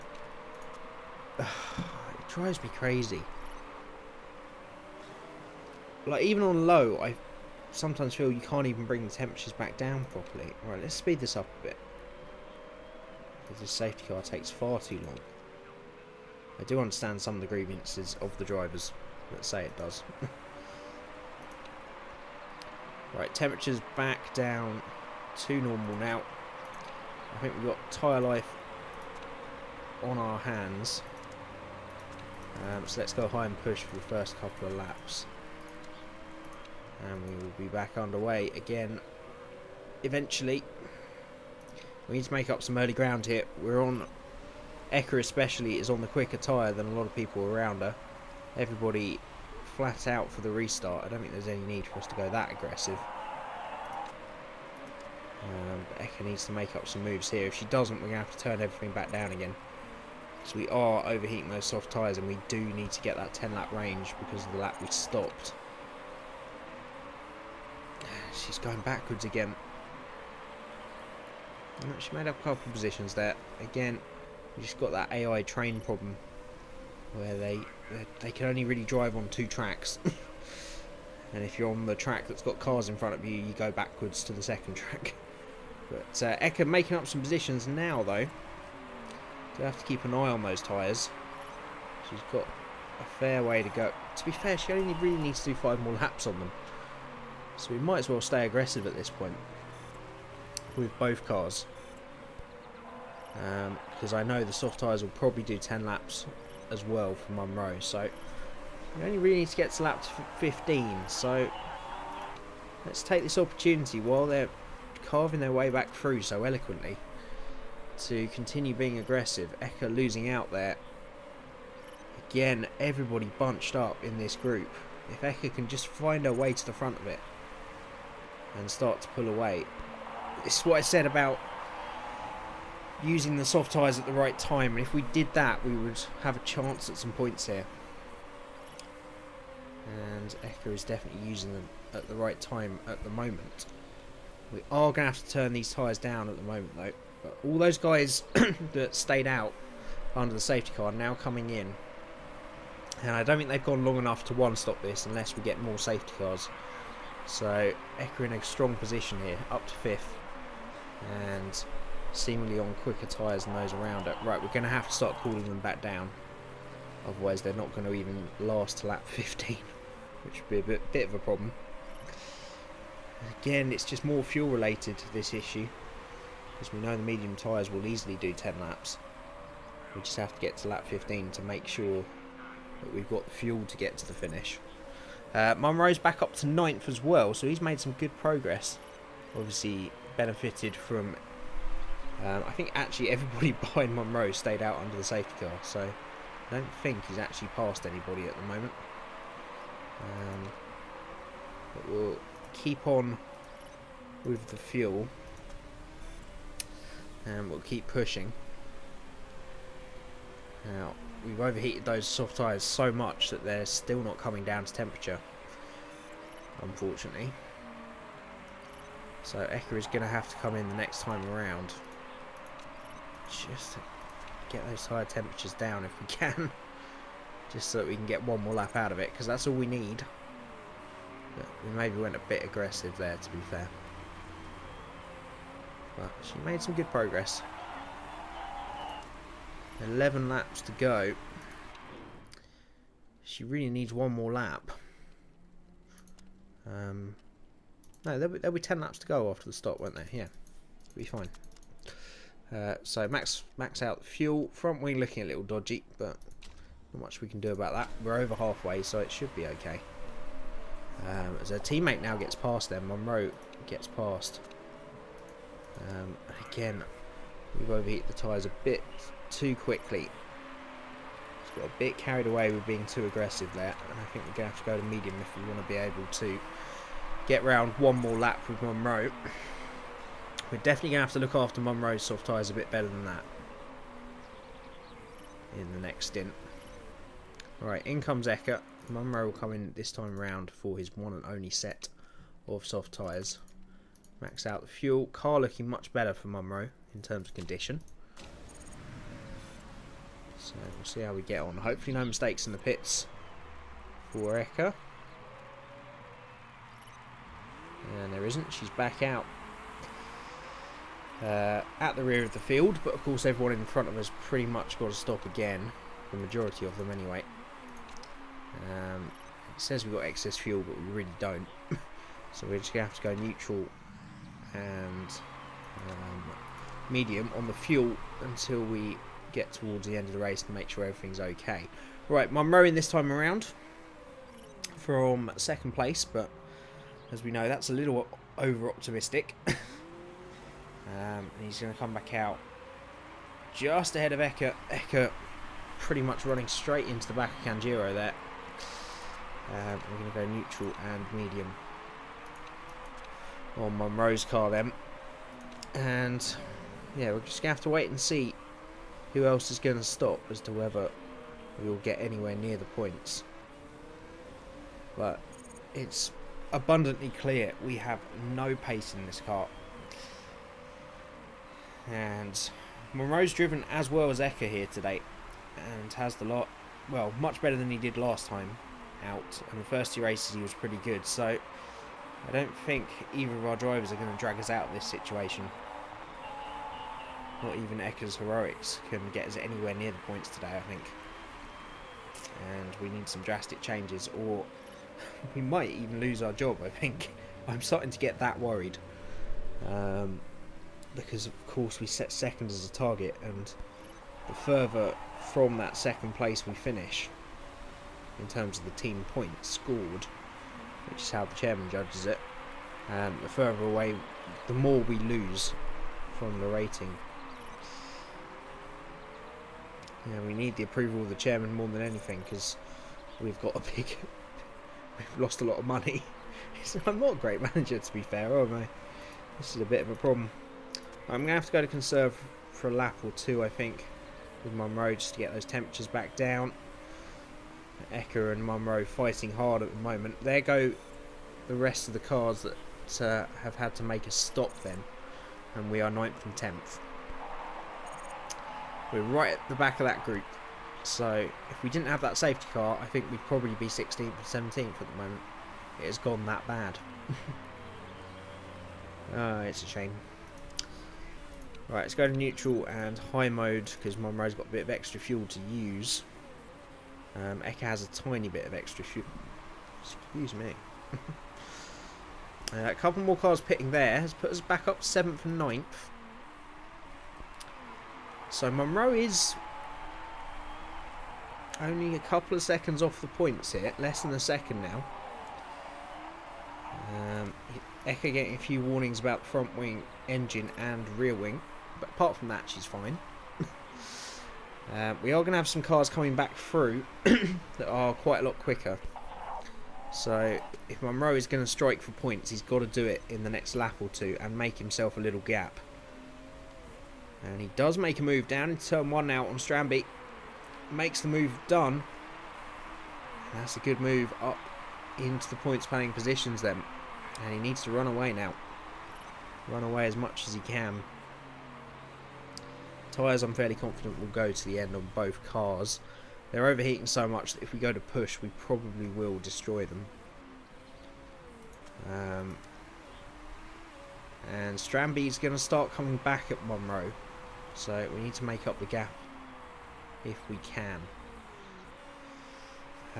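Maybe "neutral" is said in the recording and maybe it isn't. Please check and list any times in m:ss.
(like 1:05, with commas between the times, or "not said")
5:23, 5:50, 7:42.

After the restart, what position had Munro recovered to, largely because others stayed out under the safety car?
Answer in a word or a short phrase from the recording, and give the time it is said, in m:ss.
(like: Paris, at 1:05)
9th, at 3:06.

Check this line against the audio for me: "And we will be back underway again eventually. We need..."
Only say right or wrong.
right.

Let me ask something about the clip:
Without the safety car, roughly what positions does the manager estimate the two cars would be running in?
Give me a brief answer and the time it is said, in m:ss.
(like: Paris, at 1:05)
16th and 17th, at 7:33.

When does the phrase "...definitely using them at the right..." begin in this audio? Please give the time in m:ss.
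2:20.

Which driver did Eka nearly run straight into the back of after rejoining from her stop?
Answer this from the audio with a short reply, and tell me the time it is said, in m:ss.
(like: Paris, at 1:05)
Kanjiro, at 5:47.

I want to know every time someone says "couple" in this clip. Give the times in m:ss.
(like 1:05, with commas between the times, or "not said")
0:34, 1:12, 7:52, 8:01.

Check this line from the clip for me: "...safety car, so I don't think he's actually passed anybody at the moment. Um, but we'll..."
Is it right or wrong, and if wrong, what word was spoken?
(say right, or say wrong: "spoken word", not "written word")
right.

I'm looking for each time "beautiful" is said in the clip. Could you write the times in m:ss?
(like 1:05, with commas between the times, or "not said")
not said.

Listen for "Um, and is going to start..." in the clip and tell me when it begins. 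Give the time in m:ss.
8:51.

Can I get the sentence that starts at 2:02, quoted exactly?
Again, everybody bunched up in this group.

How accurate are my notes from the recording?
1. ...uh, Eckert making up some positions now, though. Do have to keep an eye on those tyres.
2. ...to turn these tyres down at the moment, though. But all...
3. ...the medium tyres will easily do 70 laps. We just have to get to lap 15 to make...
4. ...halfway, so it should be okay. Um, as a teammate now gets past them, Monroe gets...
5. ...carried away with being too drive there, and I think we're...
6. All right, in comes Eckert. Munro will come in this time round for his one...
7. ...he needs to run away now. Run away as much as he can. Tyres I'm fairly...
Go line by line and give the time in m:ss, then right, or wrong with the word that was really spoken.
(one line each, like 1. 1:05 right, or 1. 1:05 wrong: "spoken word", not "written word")
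1. 1:26 wrong: "Eka", not "Eckert"
2. 2:25 right
3. 2:56 wrong: "10", not "70"
4. 4:18 right
5. 4:31 wrong: "aggressive", not "drive"
6. 4:47 right
7. 8:37 right.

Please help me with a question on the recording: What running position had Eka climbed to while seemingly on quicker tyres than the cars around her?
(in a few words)
5th.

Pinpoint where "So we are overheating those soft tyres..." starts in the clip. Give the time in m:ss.
1:00.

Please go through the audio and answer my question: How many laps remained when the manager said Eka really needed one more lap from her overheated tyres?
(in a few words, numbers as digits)
11.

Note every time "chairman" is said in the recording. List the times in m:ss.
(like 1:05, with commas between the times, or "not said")
6:51, 7:01.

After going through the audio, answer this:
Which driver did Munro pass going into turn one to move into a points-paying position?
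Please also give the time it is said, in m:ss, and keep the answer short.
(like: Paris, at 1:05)
Stranby, at 8:29.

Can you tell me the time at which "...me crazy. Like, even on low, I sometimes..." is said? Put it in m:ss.
0:02.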